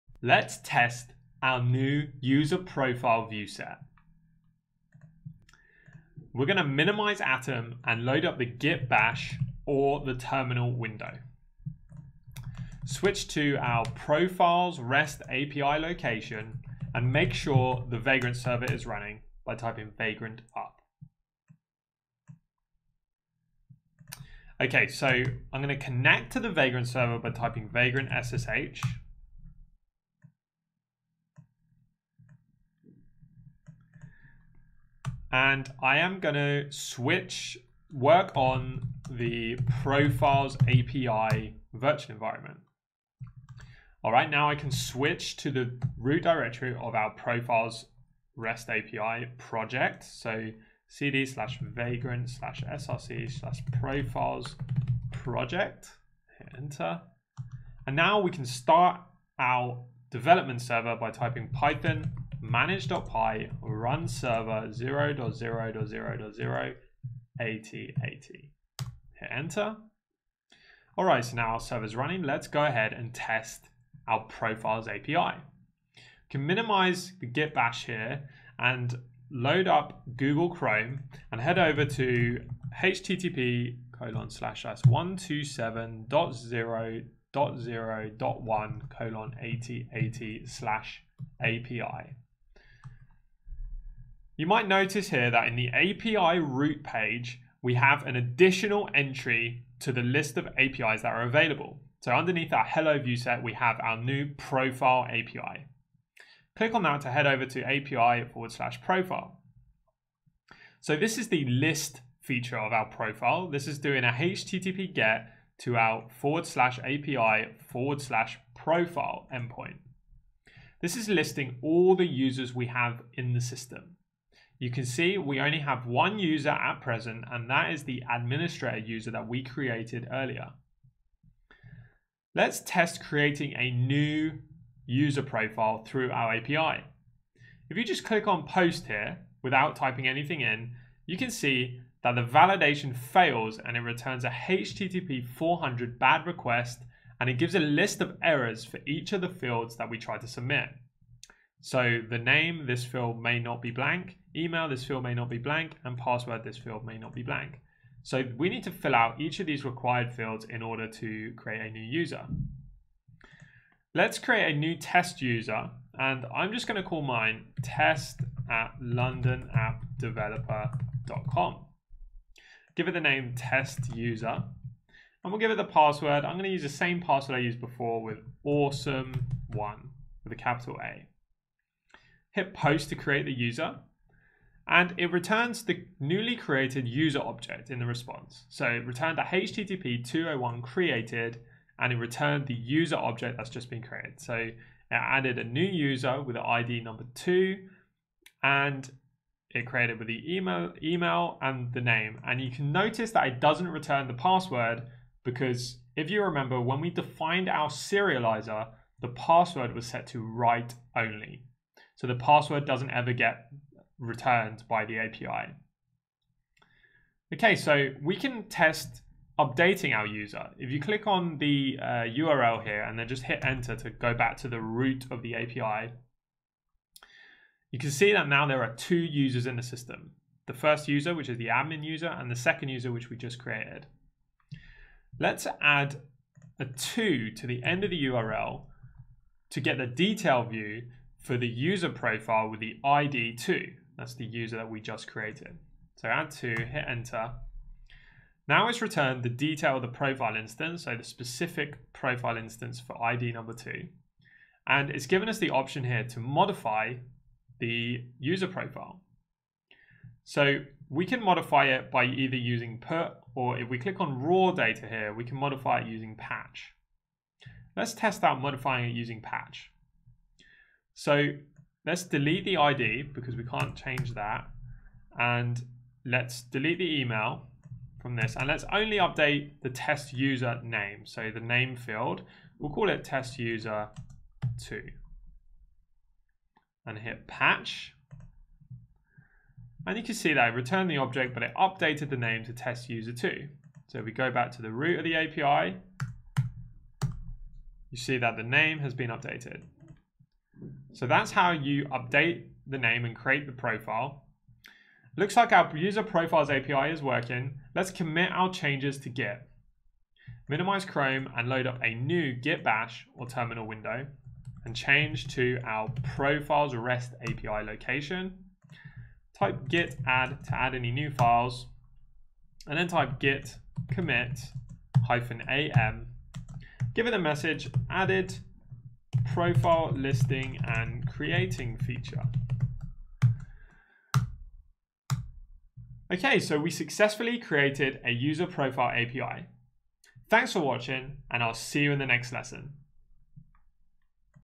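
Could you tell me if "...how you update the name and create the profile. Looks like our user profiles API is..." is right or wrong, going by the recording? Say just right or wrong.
right.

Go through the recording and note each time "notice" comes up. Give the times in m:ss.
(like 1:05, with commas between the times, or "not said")
1:34, 3:22.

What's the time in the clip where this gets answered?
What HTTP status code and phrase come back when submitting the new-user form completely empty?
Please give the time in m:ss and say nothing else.
2:25.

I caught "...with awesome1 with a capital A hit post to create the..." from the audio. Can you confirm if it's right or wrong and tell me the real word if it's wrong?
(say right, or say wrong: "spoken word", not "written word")
right.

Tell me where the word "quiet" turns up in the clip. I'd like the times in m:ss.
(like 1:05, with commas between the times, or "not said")
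not said.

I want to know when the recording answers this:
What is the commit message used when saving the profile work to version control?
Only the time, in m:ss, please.
5:27.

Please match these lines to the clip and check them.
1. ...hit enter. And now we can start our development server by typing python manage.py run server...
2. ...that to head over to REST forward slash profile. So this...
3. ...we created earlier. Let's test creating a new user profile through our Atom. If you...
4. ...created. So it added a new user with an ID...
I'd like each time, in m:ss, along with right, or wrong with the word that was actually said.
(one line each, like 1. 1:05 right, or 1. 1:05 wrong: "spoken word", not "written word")
1. 0:56 right
2. 1:46 wrong: "API", not "REST"
3. 2:09 wrong: "API", not "Atom"
4. 3:13 right.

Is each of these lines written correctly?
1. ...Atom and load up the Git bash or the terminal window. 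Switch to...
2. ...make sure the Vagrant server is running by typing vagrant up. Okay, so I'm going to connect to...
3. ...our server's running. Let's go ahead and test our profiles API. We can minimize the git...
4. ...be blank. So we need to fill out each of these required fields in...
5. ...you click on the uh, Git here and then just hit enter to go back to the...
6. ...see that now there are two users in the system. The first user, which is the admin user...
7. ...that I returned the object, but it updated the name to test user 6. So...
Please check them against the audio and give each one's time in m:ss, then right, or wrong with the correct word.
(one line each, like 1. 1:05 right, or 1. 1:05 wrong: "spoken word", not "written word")
1. 0:07 right
2. 0:17 right
3. 1:11 right
4. 2:37 right
5. 3:40 wrong: "URL", not "Git"
6. 3:47 right
7. 4:50 wrong: "2", not "6".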